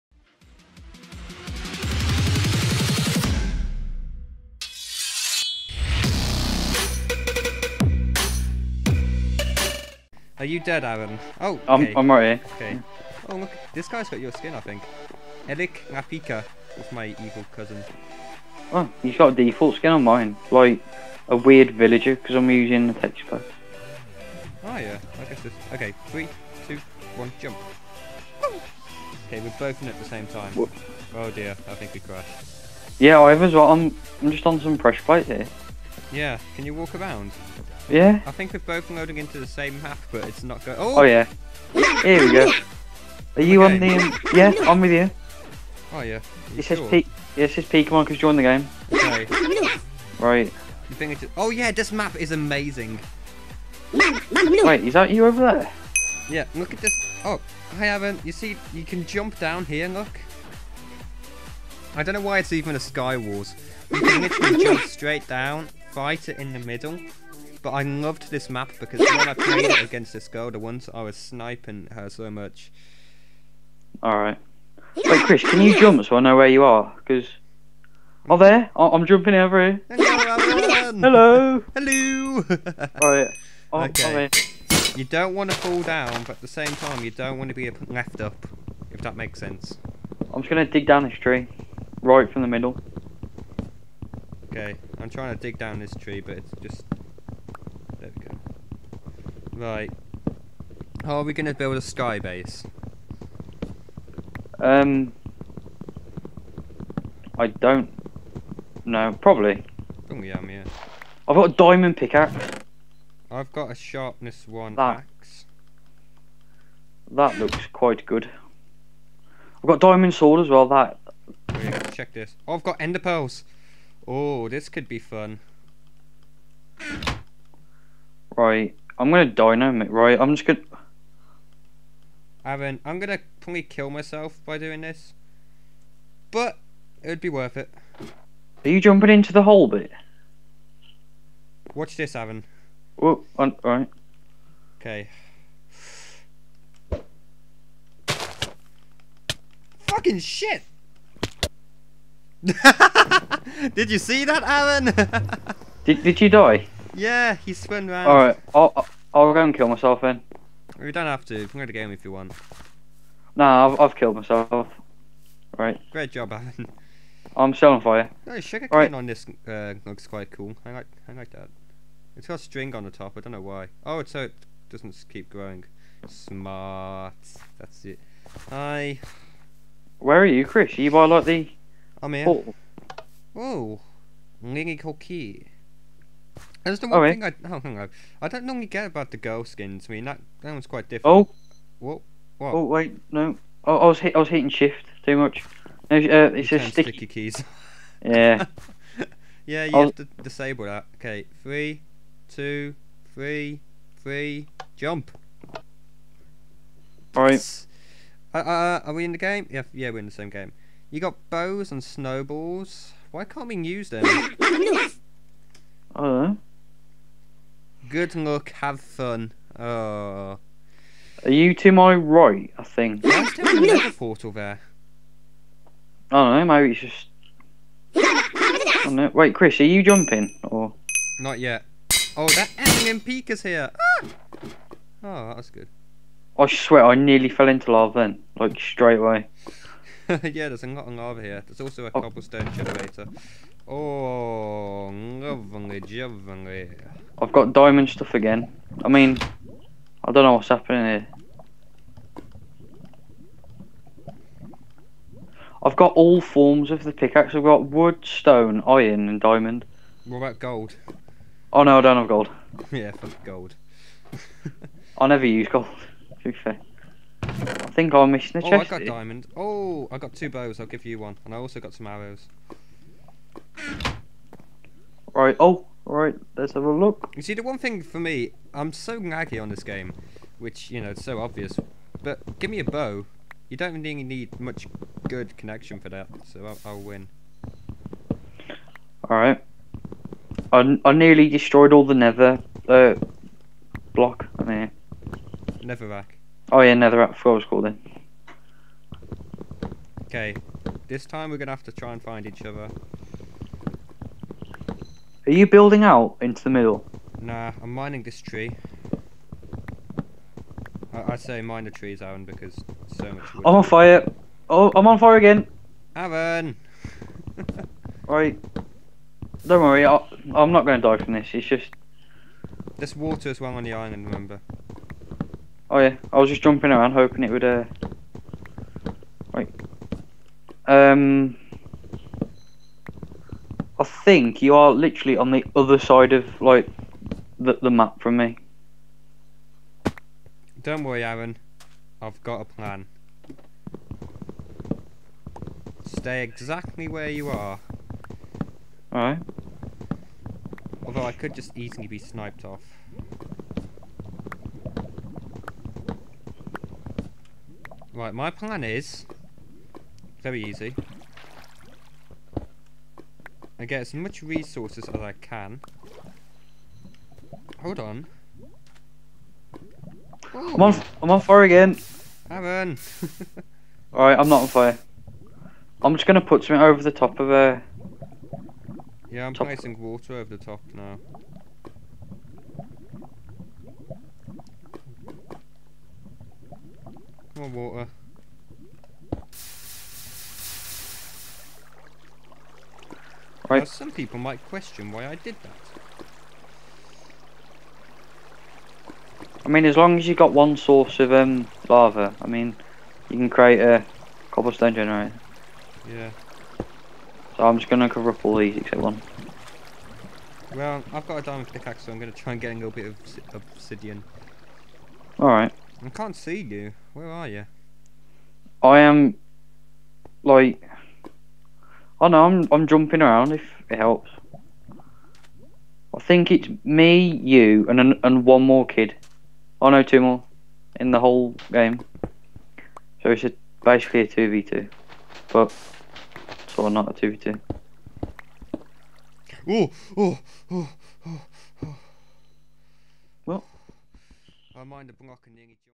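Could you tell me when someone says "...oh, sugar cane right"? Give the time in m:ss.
2:48.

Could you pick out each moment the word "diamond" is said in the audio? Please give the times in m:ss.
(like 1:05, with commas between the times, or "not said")
1:51, 1:59, 4:07, 4:19, 4:28, 6:51.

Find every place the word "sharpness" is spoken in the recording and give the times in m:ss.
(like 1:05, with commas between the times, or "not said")
1:53.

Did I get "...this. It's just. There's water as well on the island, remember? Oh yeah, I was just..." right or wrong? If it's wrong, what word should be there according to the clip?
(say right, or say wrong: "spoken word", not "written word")
right.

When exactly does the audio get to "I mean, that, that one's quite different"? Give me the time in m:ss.
3:09.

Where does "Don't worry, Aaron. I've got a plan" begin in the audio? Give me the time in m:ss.
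5:40.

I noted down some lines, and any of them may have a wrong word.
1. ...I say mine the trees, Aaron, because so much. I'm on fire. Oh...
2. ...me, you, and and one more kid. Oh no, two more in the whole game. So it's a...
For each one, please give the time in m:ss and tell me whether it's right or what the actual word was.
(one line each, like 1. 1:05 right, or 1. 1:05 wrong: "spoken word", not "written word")
1. 5:11 right
2. 7:06 right.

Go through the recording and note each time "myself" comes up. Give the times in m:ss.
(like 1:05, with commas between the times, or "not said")
2:13, 2:39, 2:44.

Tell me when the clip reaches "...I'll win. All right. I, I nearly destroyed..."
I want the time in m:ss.
4:46.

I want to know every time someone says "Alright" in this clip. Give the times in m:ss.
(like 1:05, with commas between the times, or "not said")
1:14, 1:23, 2:38, 3:27, 5:18, 5:48, 6:13, 6:55.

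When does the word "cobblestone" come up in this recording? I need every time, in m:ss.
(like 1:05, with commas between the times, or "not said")
4:02, 6:44.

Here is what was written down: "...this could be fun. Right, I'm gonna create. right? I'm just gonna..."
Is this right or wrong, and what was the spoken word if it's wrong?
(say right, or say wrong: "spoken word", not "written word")
wrong: "dynamite", not "create".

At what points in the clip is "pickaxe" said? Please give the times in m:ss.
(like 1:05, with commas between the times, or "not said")
1:51, 4:16, 6:51.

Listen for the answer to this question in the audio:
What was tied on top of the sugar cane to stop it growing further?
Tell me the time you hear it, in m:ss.
2:52.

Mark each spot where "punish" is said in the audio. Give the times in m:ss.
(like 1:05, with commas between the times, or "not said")
not said.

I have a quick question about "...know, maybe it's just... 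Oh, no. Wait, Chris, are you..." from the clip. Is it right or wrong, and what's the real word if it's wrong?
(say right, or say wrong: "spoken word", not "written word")
right.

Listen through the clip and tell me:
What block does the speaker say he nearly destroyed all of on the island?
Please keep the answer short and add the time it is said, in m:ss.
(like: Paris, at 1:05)
Netherrack, at 4:55.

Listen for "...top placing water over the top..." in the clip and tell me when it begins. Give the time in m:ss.
6:19.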